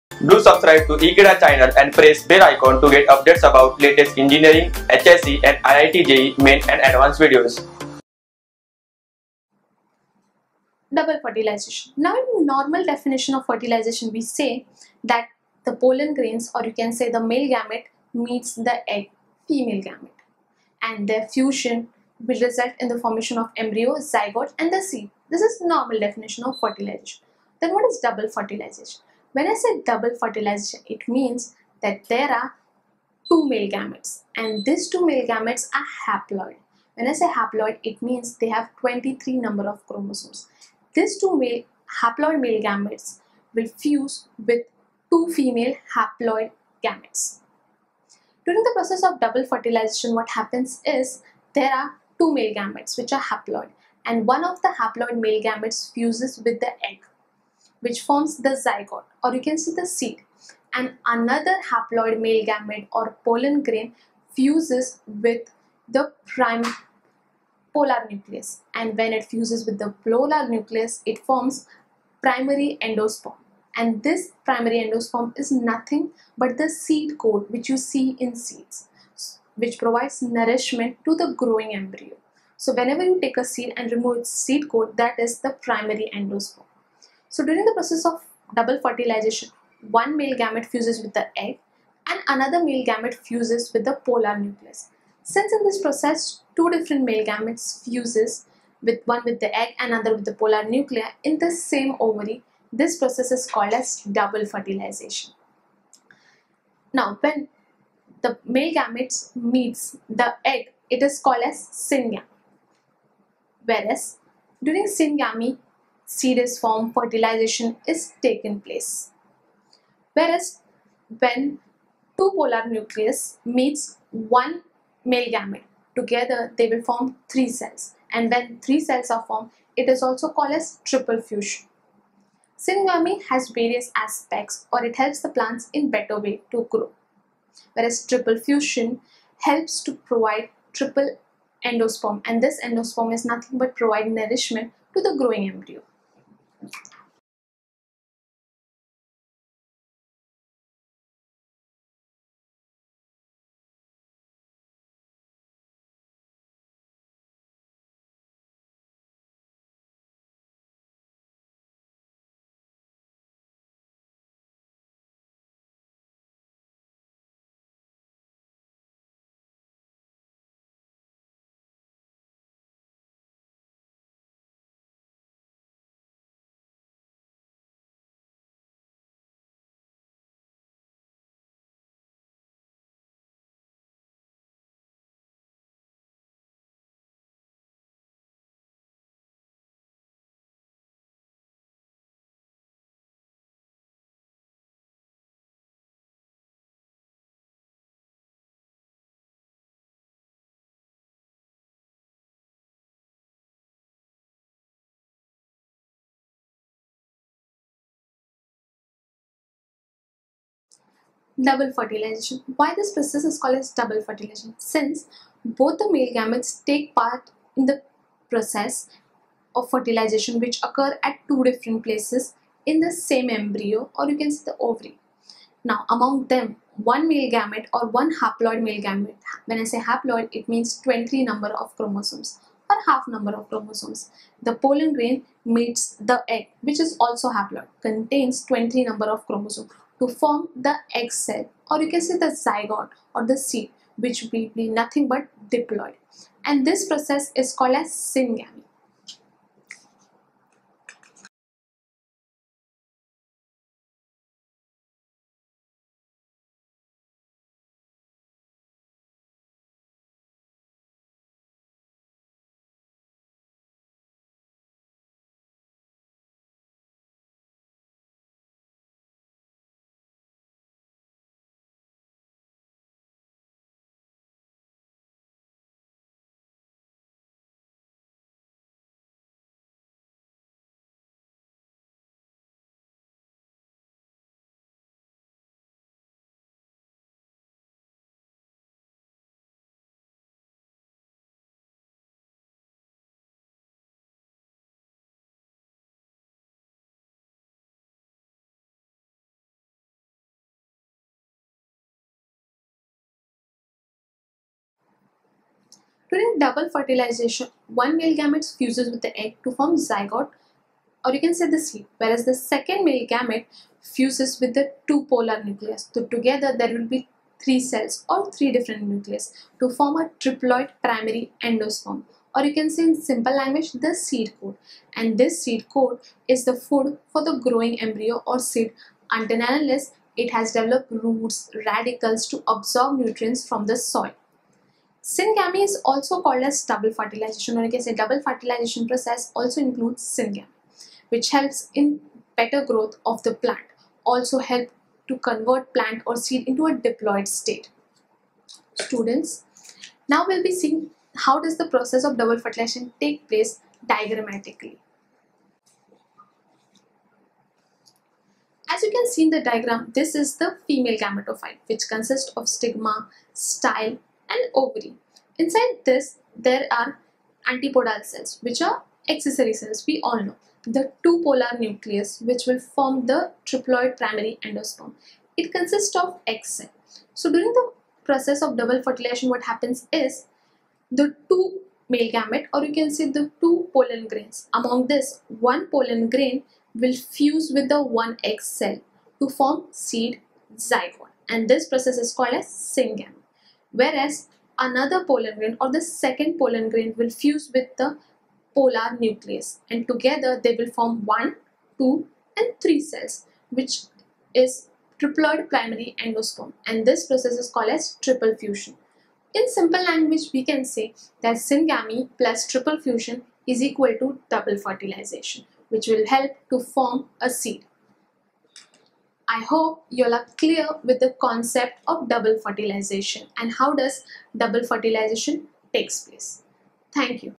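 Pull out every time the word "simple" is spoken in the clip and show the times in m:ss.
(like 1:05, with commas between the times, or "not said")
5:23, 6:49.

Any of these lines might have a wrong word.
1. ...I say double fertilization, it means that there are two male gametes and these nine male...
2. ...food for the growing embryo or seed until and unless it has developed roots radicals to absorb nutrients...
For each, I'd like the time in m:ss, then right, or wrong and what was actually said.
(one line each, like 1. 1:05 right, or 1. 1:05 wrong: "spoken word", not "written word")
1. 0:29 wrong: "two", not "nine"
2. 5:26 right.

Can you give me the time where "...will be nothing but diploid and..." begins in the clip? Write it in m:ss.
4:04.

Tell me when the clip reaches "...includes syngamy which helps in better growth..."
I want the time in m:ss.
5:39.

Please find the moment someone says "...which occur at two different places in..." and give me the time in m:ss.
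3:40.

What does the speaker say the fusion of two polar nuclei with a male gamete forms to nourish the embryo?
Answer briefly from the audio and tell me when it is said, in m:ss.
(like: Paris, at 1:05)
triple endosperm, at 2:20.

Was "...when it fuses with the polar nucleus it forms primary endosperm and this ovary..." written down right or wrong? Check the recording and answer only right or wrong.
wrong.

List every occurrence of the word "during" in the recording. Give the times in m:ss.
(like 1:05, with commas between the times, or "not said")
0:48, 1:27, 1:54, 5:06, 6:17.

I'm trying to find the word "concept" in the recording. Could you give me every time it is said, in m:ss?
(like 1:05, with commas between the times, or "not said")
7:01.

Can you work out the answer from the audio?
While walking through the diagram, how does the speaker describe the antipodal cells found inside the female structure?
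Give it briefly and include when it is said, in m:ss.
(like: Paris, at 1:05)
accessory cells, at 6:09.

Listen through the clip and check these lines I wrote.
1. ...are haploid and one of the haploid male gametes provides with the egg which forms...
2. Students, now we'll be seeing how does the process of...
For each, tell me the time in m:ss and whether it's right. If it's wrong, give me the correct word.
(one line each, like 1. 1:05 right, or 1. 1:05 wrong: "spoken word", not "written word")
1. 0:53 wrong: "fuses", not "provides"
2. 5:48 right.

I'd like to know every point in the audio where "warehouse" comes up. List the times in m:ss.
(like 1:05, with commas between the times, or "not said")
not said.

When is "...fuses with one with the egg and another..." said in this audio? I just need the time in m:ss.
1:37.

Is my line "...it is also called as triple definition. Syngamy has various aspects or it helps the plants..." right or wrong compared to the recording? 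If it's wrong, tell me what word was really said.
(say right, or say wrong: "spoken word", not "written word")
wrong: "fusion", not "definition".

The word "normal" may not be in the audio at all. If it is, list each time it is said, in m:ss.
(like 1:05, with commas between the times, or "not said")
0:12, 0:25.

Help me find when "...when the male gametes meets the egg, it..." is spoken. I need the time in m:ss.
1:47.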